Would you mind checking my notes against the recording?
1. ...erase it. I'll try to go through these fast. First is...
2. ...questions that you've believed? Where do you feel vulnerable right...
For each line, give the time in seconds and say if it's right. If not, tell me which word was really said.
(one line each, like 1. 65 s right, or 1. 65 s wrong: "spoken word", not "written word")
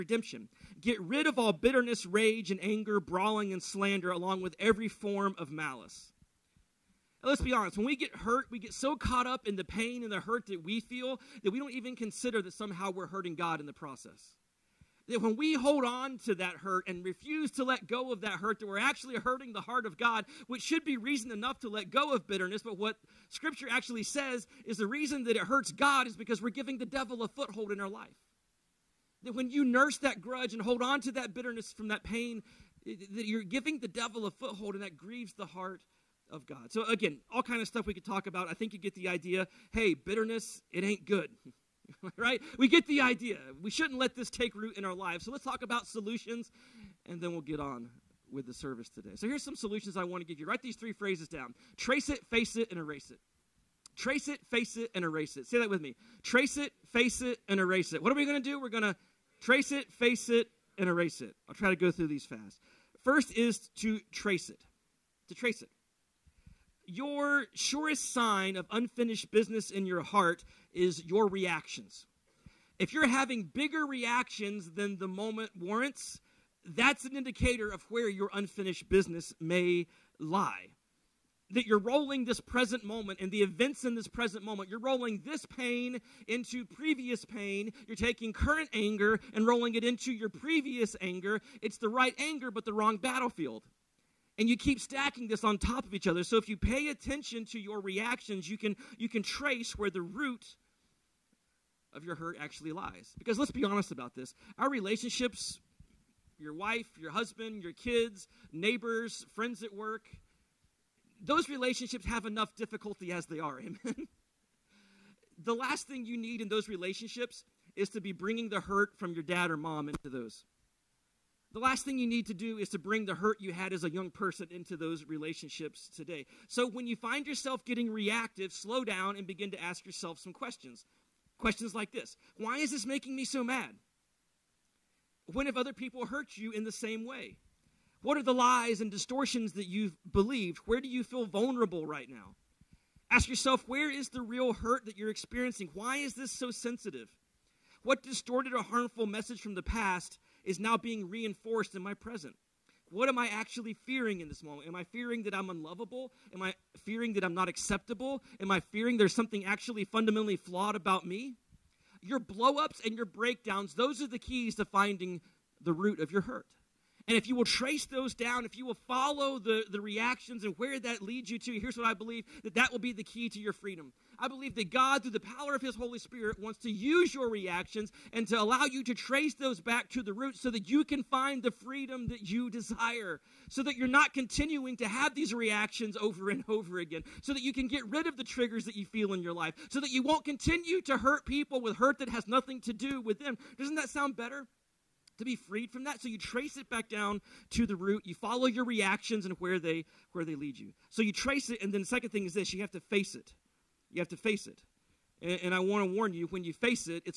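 1. 60 s right
2. 138 s wrong: "distortions", not "questions".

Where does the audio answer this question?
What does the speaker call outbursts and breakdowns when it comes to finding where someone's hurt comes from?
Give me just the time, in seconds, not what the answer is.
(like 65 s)
164 s.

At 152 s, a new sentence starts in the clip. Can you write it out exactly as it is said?
What am I actually fearing in this moment?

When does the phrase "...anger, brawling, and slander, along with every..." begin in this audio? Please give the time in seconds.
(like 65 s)
2 s.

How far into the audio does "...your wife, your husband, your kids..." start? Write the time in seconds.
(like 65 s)
106 s.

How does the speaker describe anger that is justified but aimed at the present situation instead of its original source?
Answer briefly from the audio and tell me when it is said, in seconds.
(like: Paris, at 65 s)
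the wrong battlefield, at 92 s.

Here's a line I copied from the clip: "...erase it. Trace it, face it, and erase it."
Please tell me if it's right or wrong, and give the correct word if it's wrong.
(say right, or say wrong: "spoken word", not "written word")
right.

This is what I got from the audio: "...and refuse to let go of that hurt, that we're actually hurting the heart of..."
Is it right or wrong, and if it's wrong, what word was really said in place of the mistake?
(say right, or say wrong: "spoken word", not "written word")
right.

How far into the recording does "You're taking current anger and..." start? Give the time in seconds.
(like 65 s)
87 s.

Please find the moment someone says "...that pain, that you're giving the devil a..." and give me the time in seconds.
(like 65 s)
31 s.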